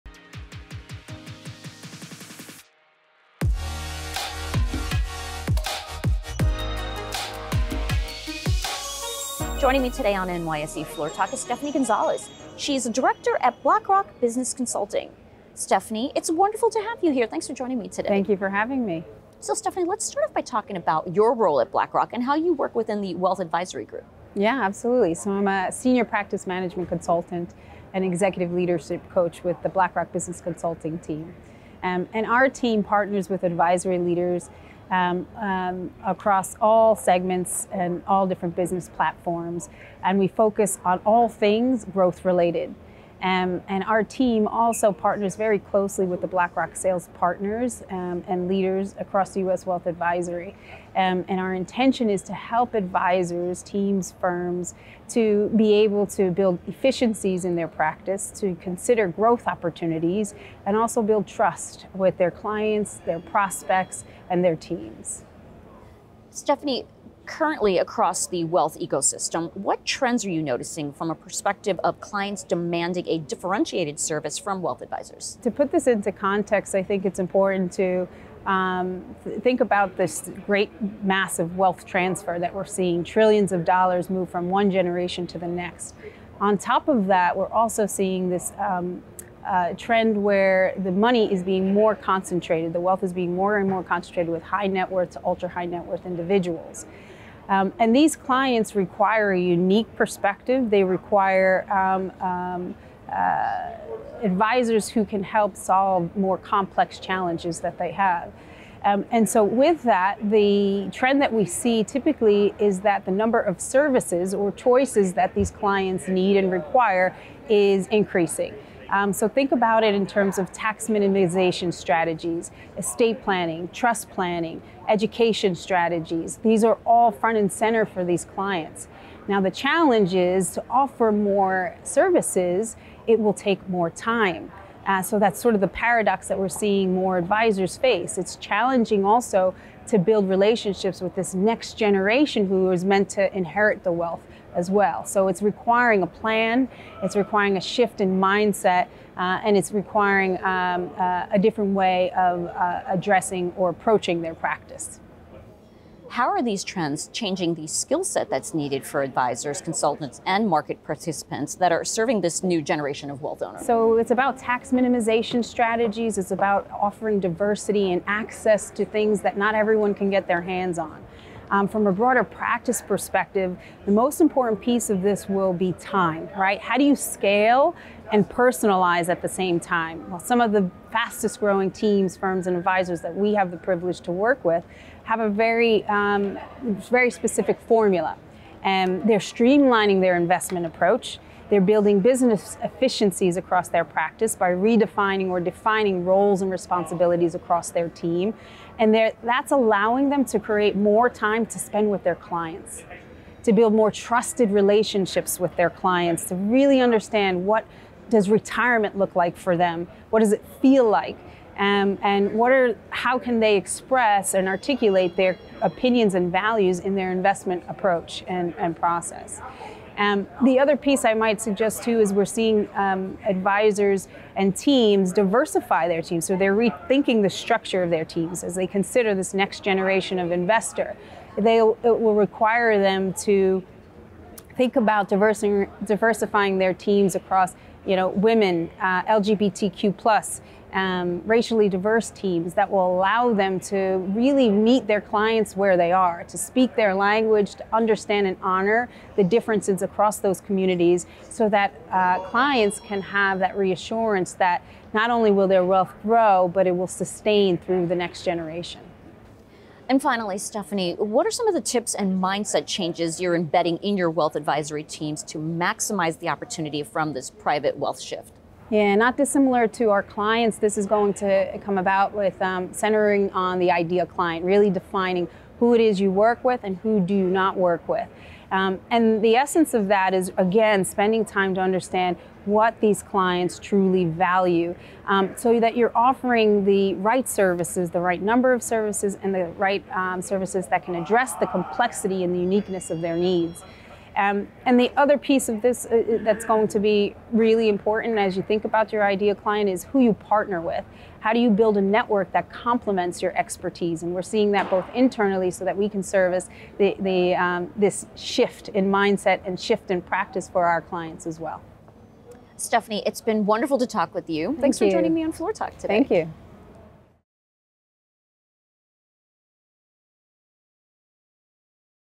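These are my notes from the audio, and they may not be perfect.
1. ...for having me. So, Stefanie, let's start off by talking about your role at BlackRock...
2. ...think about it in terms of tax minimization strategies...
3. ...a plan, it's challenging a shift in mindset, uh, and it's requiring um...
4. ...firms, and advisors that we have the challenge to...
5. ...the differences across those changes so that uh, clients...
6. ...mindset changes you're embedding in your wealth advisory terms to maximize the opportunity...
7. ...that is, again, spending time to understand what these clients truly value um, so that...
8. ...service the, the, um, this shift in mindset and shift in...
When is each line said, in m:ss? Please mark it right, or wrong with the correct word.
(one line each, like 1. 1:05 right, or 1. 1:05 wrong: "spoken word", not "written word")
1. 0:18 right
2. 1:59 right
3. 2:26 wrong: "requiring", not "challenging"
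4. 3:02 wrong: "privilege", not "challenge"
5. 4:09 wrong: "communities", not "changes"
6. 4:22 wrong: "teams", not "terms"
7. 4:39 right
8. 5:06 right.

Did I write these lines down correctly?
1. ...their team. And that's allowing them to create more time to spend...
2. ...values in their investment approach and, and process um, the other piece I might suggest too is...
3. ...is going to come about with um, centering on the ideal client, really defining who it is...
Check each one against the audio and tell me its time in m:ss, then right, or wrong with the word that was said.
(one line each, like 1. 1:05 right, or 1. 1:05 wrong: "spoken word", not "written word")
1. 3:17 right
2. 3:36 right
3. 4:30 right.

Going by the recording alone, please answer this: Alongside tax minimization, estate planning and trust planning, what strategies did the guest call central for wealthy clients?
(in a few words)
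education strategies.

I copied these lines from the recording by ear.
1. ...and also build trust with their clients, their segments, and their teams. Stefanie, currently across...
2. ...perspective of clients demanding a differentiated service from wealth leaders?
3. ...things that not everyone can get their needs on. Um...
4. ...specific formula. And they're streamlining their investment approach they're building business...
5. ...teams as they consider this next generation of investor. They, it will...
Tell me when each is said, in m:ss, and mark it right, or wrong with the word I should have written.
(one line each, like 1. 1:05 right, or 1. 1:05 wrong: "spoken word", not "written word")
1. 1:00 wrong: "prospects", not "segments"
2. 1:11 wrong: "advisors", not "leaders"
3. 2:48 wrong: "hands", not "needs"
4. 3:07 right
5. 3:48 right.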